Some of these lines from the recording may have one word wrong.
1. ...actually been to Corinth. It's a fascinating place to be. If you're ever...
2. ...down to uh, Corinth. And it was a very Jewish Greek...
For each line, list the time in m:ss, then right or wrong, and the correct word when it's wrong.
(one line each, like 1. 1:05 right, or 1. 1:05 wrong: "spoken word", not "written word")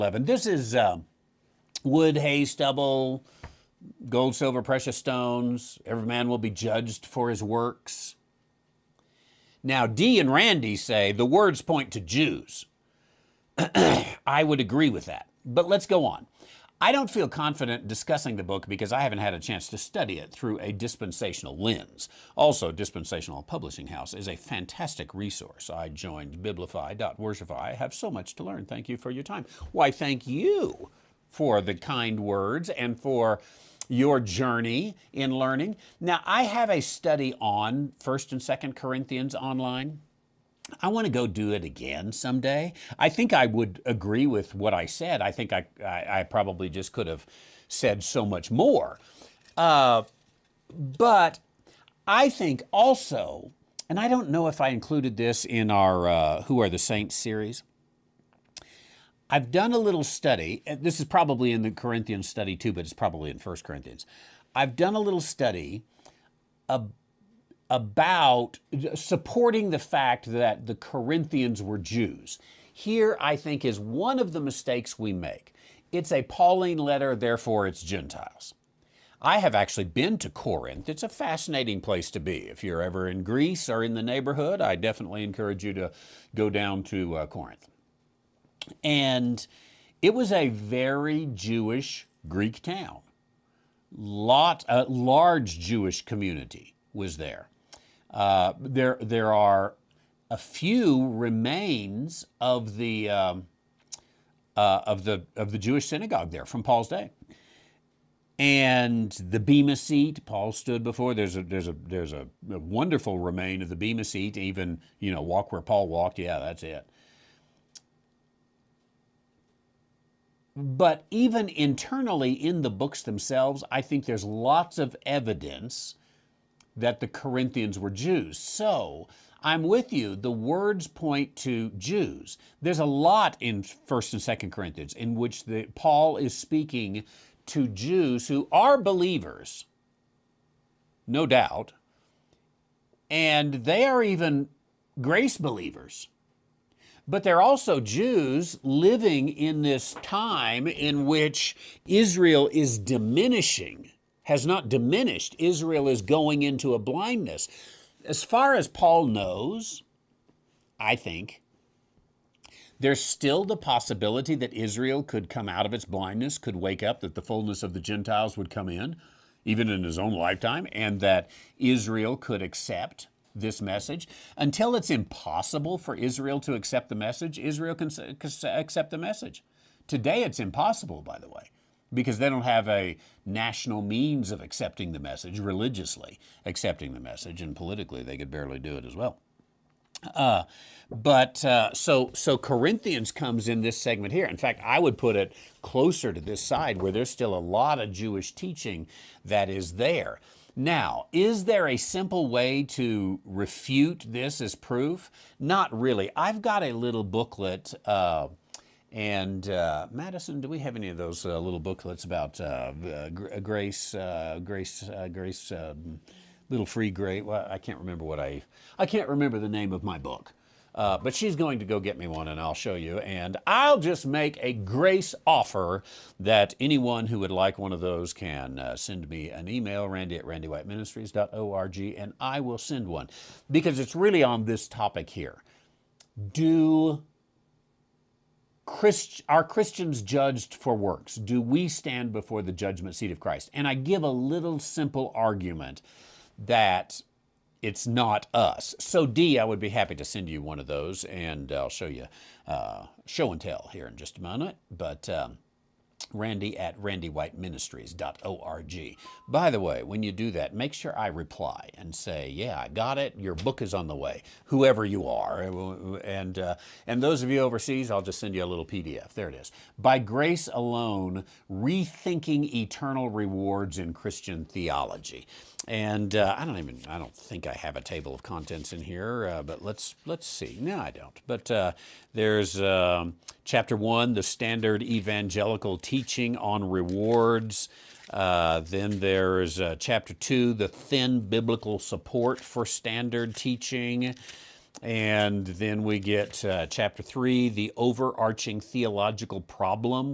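1. 1:19 right
2. 1:26 right.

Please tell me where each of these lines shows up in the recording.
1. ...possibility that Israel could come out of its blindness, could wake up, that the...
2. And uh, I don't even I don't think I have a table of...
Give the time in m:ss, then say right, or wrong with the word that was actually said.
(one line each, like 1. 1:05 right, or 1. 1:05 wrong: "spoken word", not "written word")
1. 2:43 right
2. 4:35 right.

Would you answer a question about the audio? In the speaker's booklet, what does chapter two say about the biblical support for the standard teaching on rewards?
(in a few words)
thin.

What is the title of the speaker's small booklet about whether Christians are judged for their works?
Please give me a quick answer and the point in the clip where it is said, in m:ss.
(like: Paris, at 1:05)
By Grace Alone, at 4:29.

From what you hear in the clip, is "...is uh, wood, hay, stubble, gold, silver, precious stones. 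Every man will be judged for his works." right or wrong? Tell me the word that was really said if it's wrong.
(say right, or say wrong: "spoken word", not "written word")
right.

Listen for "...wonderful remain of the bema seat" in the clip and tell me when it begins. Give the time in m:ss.
1:52.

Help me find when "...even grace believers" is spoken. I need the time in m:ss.
2:24.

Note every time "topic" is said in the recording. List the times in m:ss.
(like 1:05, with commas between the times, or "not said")
3:54.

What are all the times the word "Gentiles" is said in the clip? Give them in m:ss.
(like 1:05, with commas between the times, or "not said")
1:17, 2:47.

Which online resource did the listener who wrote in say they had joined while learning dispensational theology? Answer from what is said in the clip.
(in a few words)
Biblify.worshipify.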